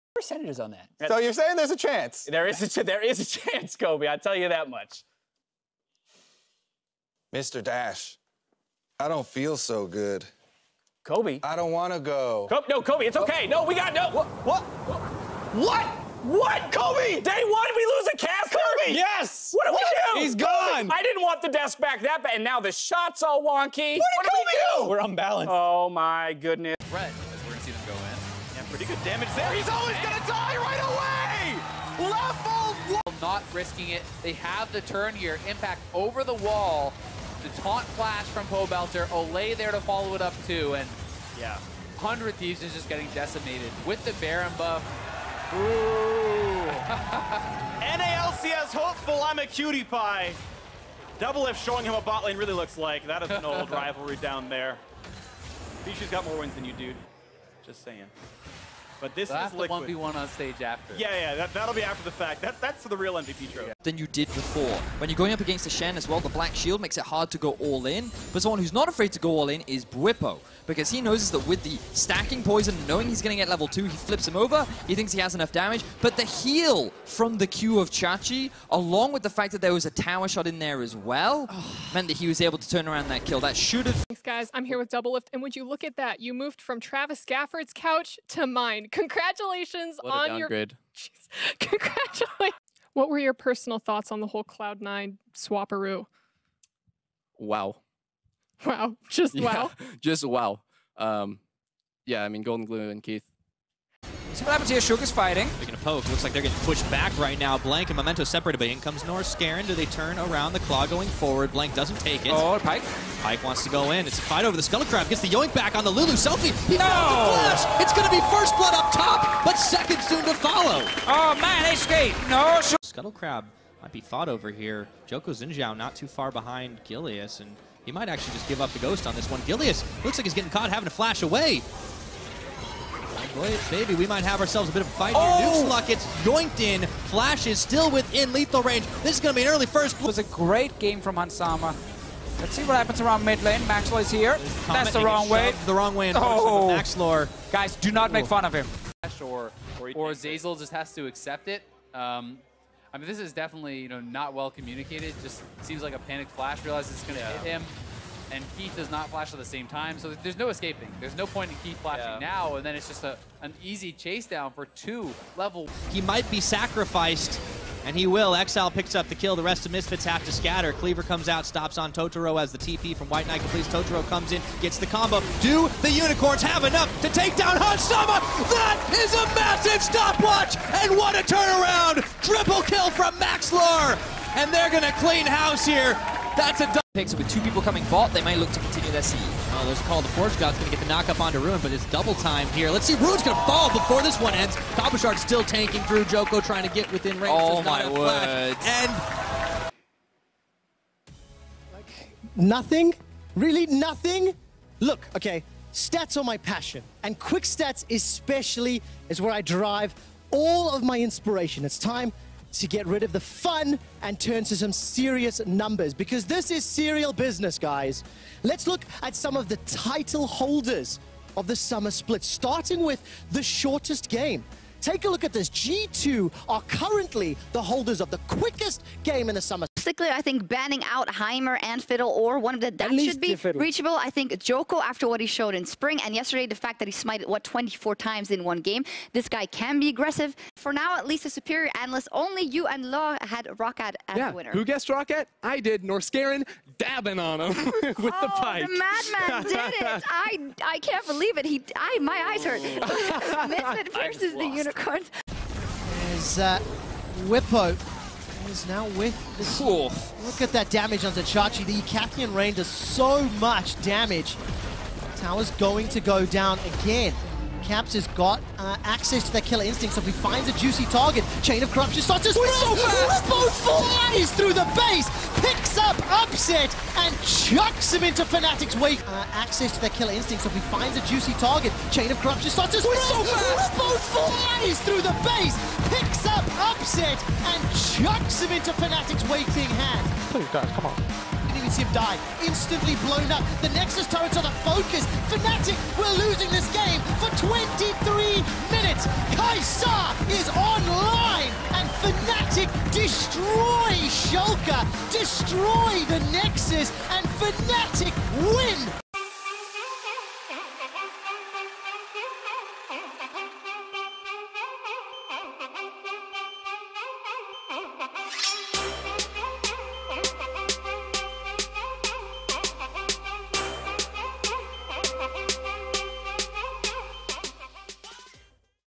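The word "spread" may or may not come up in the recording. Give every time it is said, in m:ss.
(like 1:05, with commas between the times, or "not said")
4:32, 4:42.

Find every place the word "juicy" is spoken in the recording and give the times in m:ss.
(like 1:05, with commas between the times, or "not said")
4:30, 4:41.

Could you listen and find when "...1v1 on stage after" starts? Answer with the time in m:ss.
0:59.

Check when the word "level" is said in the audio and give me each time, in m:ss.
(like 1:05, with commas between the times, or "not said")
0:32, 1:13, 2:45.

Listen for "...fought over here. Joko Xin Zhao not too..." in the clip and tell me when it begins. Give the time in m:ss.
2:04.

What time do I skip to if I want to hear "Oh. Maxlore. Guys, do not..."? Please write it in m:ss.
2:26.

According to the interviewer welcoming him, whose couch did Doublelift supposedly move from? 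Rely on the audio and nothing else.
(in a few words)
Travis Gafford.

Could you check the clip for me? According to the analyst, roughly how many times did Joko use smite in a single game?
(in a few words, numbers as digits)
24.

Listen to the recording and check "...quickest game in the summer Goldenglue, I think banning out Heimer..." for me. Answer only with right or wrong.
wrong.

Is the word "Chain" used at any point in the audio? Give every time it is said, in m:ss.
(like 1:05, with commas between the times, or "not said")
4:31, 4:41.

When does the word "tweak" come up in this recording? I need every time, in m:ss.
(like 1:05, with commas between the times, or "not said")
not said.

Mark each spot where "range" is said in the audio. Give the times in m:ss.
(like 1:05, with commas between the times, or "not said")
2:18, 3:17.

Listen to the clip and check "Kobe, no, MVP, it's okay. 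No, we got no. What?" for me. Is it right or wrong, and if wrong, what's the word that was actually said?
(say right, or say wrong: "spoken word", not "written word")
wrong: "Kobe", not "MVP".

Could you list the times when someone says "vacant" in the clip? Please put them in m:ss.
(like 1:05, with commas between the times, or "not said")
not said.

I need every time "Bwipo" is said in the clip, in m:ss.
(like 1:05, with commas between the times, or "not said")
1:09, 4:17.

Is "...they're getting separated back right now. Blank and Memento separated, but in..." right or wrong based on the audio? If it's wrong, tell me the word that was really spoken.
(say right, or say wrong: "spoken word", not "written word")
wrong: "pushed", not "separated".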